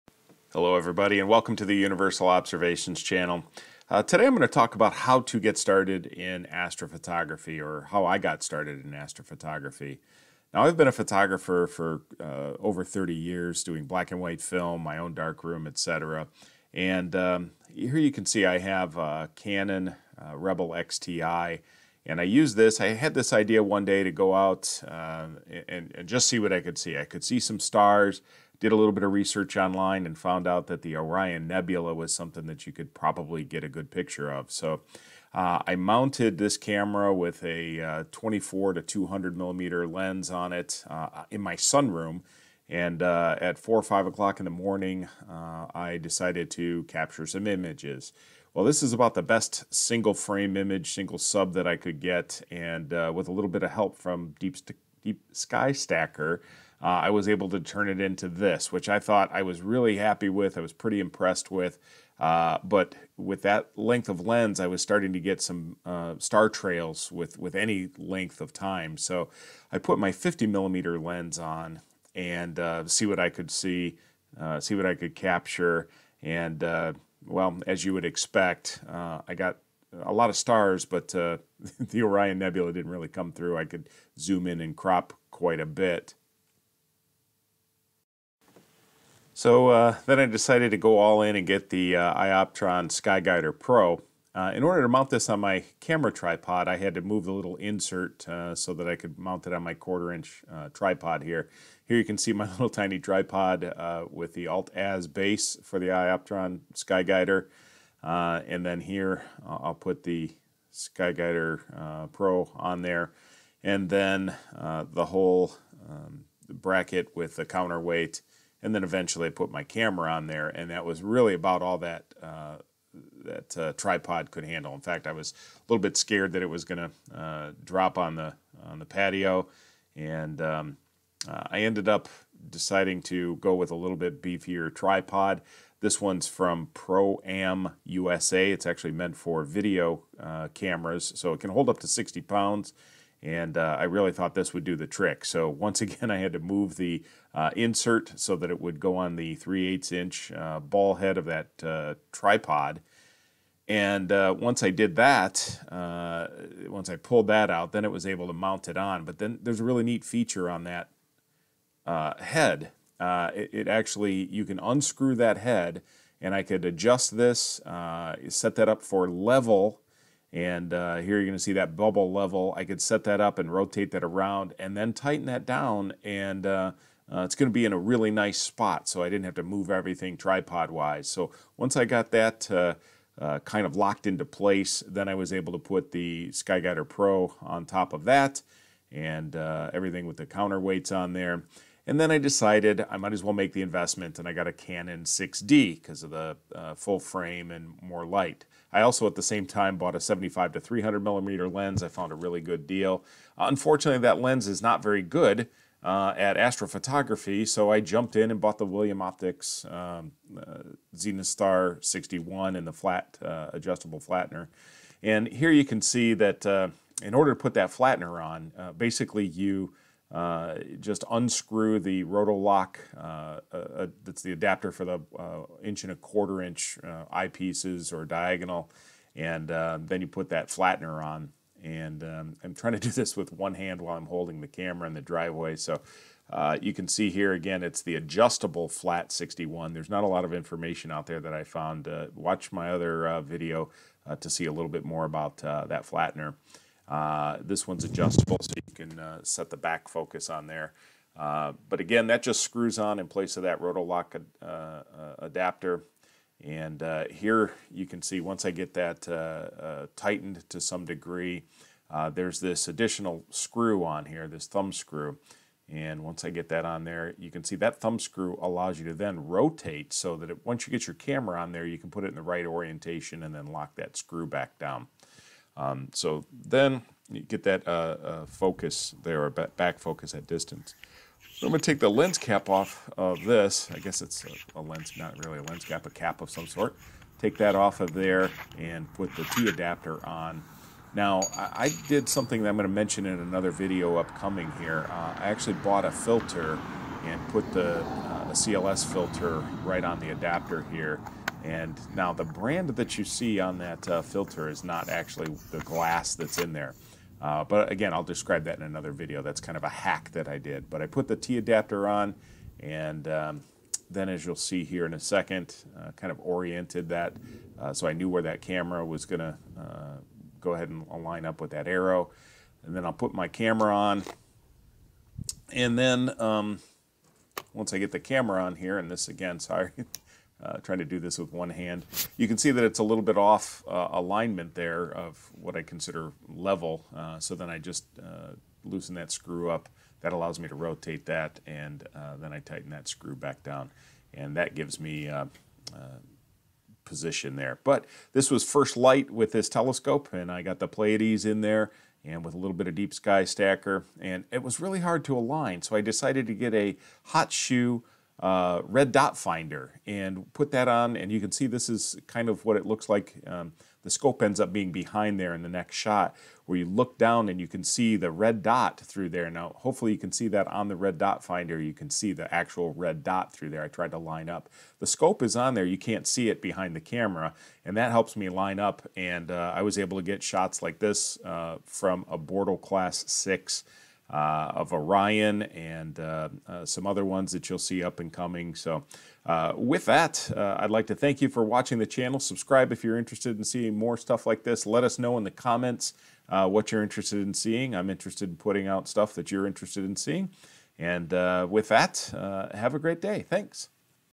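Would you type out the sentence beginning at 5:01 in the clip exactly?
And now the brand that you see on that uh, filter is not actually the glass that's in there.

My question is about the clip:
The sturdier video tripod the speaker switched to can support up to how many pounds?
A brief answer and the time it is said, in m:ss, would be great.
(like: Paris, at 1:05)
60 pounds, at 2:21.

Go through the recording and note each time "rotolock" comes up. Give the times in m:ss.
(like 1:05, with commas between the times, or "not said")
3:42, 4:13.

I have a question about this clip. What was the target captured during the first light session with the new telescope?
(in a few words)
the Pleiades.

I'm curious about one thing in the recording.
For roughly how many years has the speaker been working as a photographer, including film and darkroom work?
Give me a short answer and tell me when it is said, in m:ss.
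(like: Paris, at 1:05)
over 30 years, at 0:12.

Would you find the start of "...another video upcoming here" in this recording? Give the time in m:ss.
4:53.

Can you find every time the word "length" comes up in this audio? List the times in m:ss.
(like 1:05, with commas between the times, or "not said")
1:03, 1:07.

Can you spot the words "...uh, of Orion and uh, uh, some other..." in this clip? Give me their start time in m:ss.
6:24.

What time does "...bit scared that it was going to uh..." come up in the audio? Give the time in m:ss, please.
2:05.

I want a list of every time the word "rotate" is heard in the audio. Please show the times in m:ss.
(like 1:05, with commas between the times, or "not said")
2:53, 4:29, 5:40.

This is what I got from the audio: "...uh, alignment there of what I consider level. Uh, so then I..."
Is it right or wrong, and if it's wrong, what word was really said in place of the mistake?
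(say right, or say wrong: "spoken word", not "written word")
right.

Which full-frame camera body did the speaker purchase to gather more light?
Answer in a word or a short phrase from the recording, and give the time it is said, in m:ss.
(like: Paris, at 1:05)
Canon 6D, at 3:14.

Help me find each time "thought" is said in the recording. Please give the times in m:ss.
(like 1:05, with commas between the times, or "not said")
0:58, 2:24.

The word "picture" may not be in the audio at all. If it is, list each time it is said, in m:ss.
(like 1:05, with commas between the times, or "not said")
0:33.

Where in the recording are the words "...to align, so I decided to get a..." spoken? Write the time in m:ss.
5:55.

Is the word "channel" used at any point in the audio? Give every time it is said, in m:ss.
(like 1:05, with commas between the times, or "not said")
0:03, 6:31.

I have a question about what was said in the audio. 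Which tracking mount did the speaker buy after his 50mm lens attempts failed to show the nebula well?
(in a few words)
iOptron Skyguider Pro.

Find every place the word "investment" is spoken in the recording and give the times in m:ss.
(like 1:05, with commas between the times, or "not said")
3:13.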